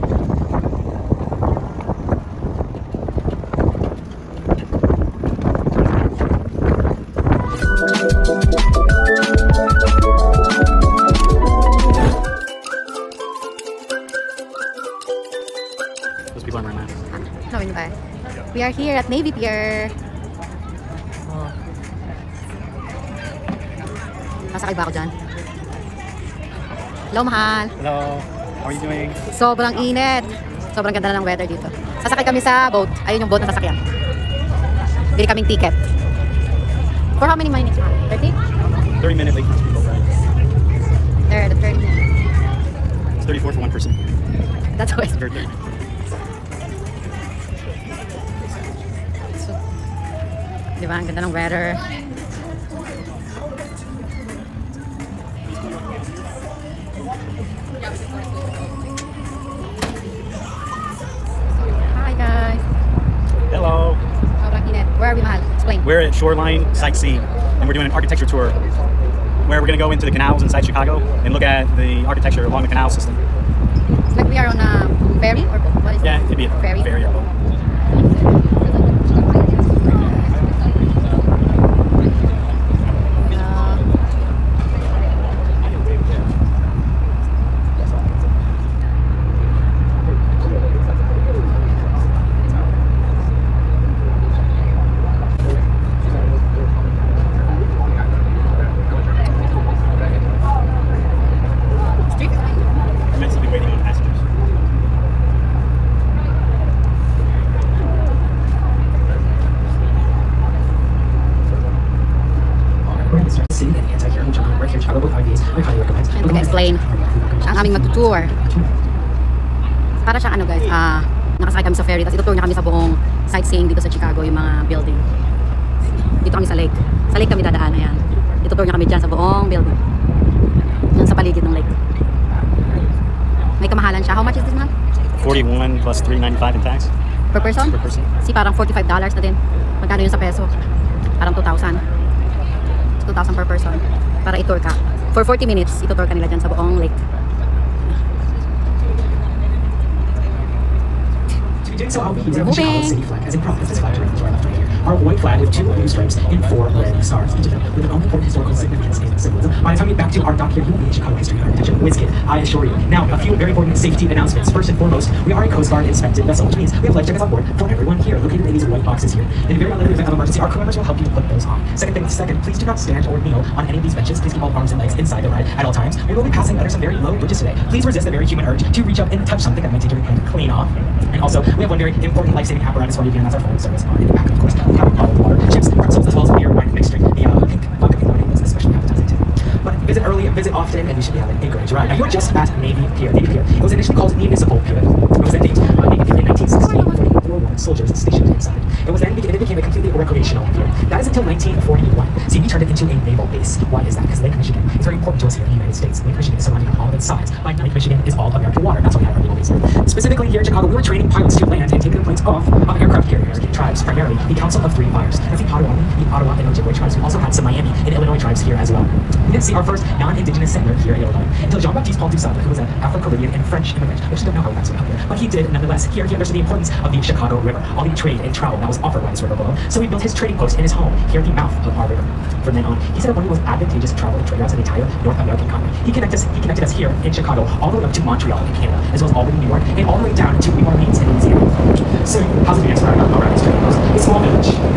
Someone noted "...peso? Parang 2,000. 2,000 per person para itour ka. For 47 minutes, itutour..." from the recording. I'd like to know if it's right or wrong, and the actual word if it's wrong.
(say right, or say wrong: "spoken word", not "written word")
wrong: "40", not "47".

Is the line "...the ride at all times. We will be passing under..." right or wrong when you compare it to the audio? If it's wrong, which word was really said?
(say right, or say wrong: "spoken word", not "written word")
right.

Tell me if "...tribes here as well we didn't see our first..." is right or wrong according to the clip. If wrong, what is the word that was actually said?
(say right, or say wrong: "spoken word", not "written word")
right.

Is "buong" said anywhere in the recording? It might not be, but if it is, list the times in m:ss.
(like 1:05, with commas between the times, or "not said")
2:02, 2:09, 2:26.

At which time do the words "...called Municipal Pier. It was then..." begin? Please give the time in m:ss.
3:13.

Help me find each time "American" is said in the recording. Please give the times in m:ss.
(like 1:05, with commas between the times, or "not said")
3:28, 3:33, 3:55.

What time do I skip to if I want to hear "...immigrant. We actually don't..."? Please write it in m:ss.
3:43.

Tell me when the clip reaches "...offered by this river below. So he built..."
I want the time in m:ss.
3:48.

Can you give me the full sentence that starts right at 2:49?
In the very unlikely event of emergency, our crew members will help you to put those on.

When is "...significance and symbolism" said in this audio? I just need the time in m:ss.
2:38.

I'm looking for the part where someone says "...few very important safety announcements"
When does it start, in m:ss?
2:43.